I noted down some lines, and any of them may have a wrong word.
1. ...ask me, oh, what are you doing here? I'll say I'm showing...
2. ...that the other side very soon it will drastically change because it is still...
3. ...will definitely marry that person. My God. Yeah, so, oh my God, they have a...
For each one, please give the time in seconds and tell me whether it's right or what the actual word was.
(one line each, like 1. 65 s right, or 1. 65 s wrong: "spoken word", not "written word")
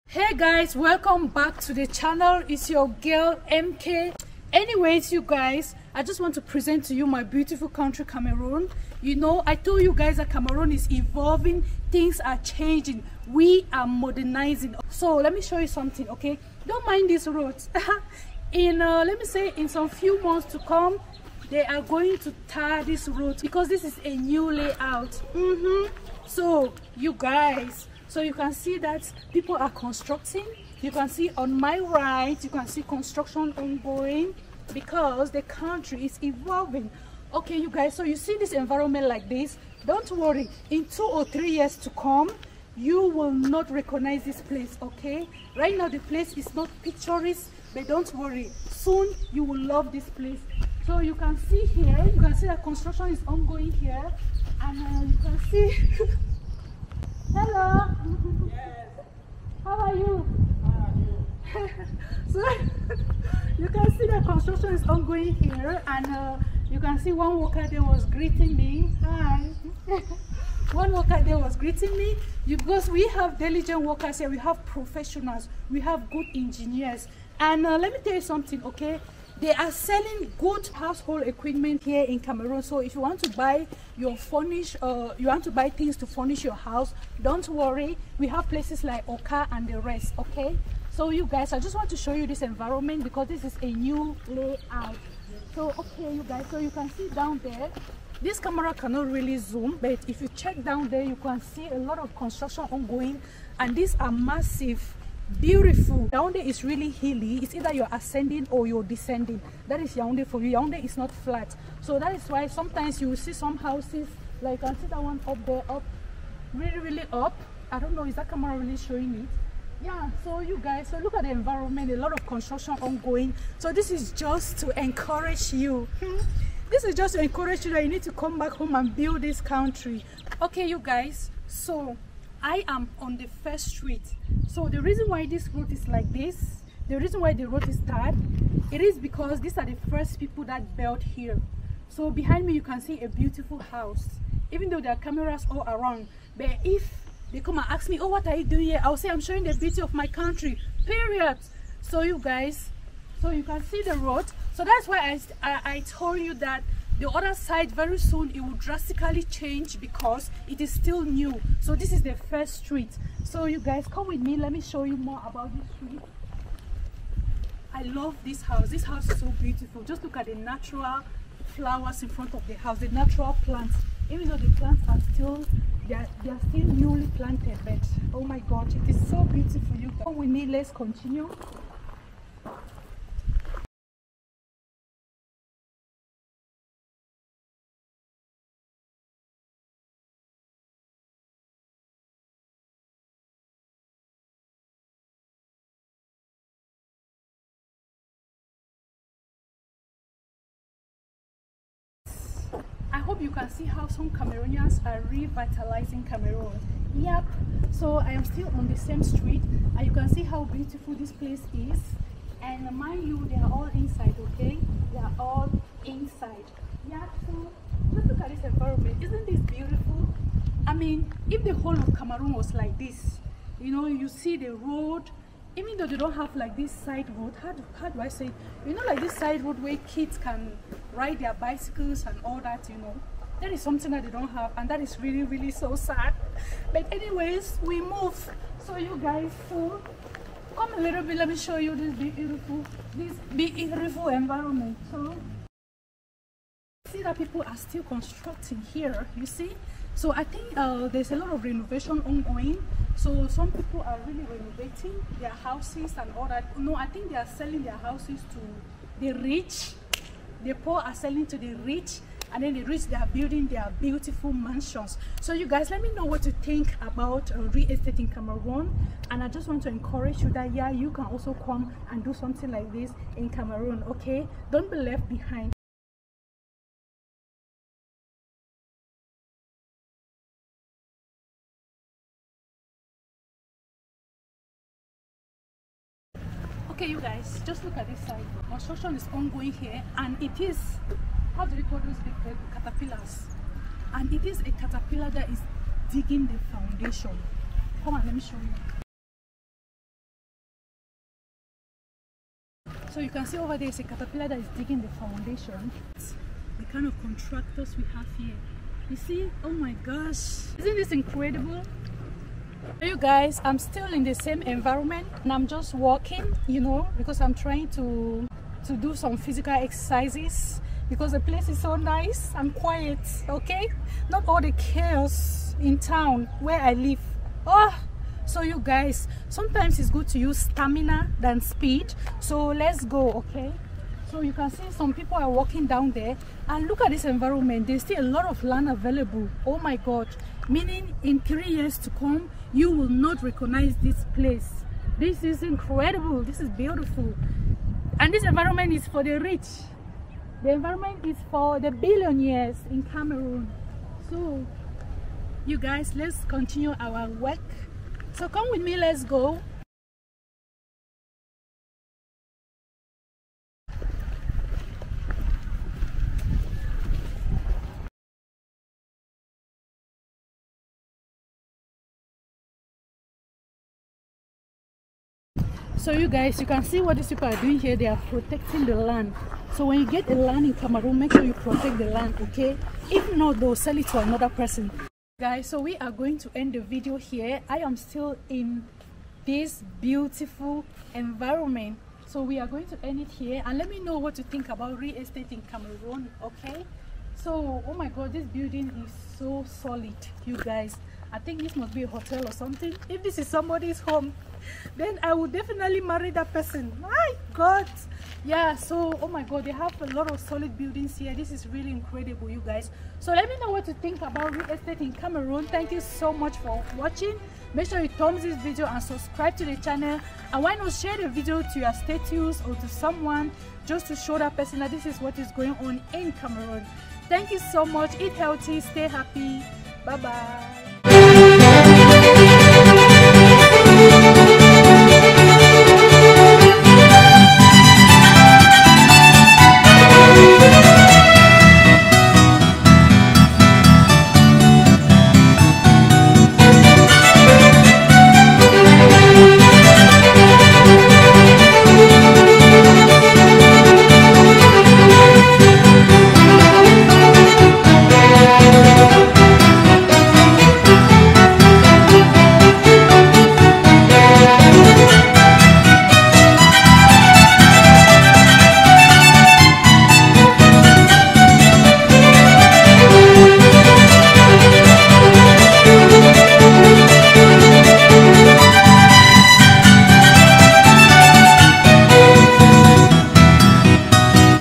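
1. 147 s right
2. 156 s right
3. 405 s right.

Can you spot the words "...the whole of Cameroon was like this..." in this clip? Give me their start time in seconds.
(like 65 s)
221 s.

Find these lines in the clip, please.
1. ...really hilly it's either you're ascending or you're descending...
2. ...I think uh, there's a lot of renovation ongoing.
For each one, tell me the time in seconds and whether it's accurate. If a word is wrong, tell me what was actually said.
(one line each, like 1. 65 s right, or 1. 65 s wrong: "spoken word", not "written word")
1. 106 s right
2. 250 s right.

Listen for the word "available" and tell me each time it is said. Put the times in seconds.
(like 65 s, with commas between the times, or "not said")
338 s.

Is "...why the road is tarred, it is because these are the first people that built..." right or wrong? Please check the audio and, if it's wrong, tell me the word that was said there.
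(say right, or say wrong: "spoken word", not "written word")
right.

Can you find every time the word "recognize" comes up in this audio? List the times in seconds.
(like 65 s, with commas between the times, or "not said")
43 s, 343 s.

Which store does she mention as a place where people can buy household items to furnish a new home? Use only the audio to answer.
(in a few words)
Orca.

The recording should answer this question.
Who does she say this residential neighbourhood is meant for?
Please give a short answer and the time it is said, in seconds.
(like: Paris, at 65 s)
Billionaires, at 351 s.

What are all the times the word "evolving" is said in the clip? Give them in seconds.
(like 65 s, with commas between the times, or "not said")
10 s, 36 s.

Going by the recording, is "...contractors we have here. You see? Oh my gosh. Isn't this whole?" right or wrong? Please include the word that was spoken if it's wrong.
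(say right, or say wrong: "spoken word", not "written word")
wrong: "incredible", not "whole".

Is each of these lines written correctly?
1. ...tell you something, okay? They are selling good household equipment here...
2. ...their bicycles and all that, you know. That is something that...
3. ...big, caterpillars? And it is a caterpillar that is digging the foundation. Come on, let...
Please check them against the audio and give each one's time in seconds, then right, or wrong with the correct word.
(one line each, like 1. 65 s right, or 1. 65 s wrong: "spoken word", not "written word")
1. 78 s right
2. 231 s right
3. 291 s right.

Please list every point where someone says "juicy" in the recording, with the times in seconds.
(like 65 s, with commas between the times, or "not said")
not said.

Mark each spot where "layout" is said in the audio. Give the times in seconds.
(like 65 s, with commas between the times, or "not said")
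24 s, 94 s.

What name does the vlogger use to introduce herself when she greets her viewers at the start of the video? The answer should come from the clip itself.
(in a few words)
MK.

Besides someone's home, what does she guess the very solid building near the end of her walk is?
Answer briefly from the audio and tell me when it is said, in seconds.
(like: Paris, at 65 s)
A hotel, at 401 s.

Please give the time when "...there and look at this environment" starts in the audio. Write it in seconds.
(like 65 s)
335 s.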